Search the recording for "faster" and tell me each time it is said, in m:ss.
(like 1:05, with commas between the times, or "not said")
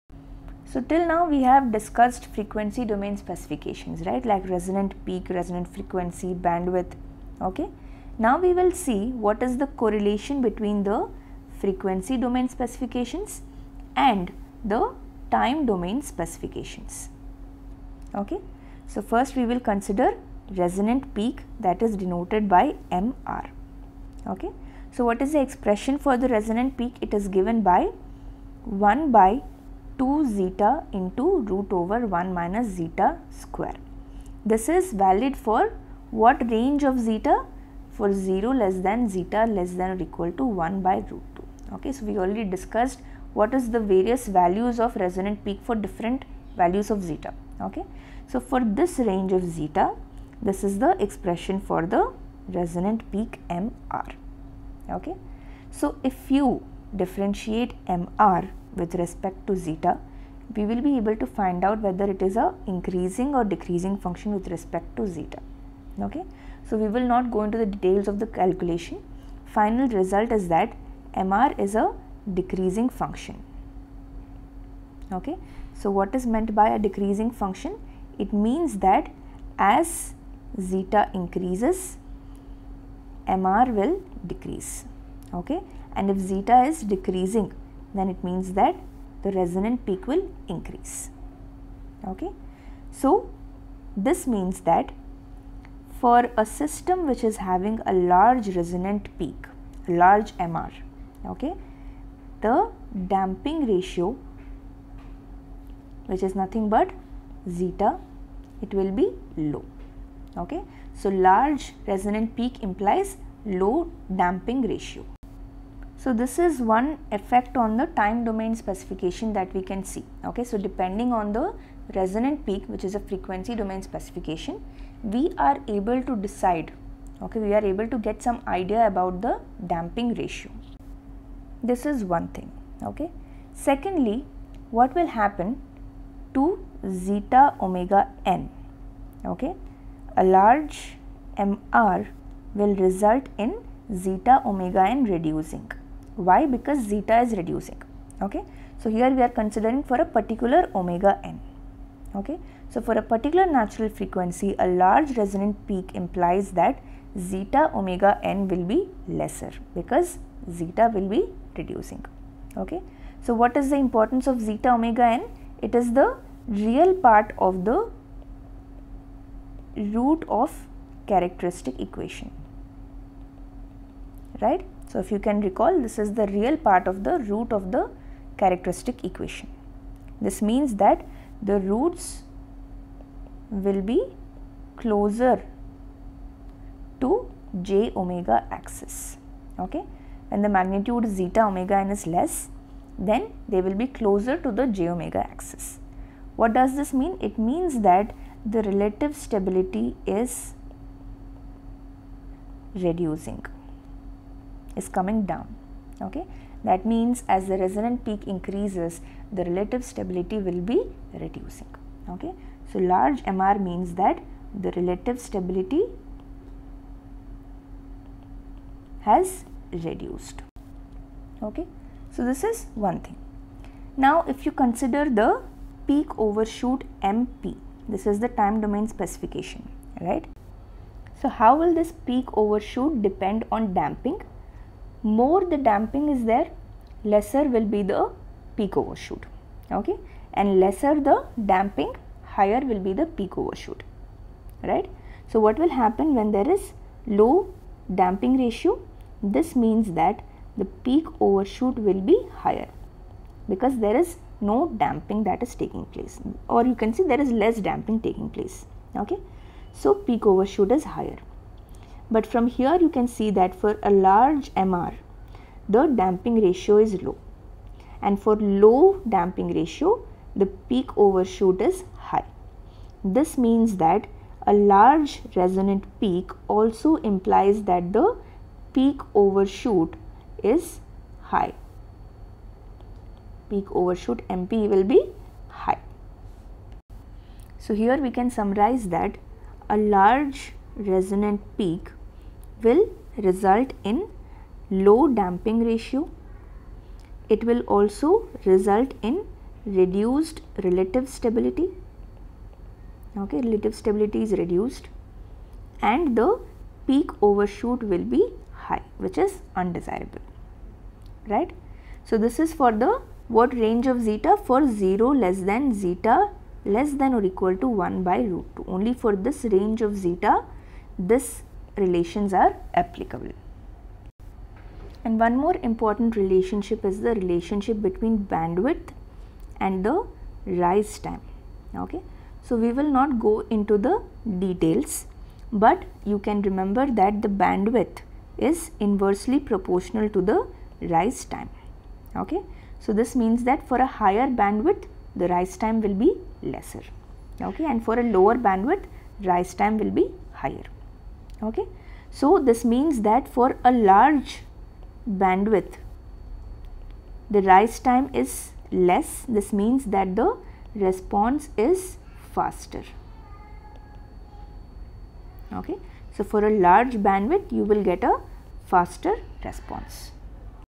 6:02, 6:08.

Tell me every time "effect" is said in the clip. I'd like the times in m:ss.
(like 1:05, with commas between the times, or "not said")
1:57.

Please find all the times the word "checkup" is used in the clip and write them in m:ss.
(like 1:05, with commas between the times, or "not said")
not said.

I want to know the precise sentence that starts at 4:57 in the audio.
It will also result in reduced relative stability.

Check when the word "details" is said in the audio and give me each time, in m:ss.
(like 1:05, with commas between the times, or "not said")
1:07, 5:34.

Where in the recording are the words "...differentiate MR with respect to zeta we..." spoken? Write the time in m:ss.
0:57.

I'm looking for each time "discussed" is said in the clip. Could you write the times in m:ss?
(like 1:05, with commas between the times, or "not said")
0:01, 0:42.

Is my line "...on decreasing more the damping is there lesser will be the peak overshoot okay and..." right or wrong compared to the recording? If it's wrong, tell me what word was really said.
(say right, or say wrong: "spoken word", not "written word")
wrong: "damping", not "decreasing".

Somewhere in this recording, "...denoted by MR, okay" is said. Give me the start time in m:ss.
0:21.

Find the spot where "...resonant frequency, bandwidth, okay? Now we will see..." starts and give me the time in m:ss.
0:05.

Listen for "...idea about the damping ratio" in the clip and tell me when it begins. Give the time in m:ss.
2:08.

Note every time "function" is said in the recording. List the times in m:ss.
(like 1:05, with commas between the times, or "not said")
1:04, 1:13, 1:17.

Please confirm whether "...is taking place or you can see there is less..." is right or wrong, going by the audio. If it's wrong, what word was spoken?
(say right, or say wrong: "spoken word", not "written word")
right.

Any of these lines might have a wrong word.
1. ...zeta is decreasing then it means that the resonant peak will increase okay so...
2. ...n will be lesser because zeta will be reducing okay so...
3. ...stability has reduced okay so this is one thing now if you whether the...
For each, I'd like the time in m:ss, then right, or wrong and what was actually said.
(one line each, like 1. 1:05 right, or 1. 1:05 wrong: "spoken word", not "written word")
1. 1:26 right
2. 2:38 right
3. 3:35 wrong: "consider", not "whether".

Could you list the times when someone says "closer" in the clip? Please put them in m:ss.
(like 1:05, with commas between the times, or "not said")
3:04, 3:13.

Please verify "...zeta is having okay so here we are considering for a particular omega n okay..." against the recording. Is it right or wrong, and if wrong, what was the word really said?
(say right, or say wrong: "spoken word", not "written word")
wrong: "reducing", not "having".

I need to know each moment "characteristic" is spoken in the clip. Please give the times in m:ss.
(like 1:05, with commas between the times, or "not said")
2:51, 2:58.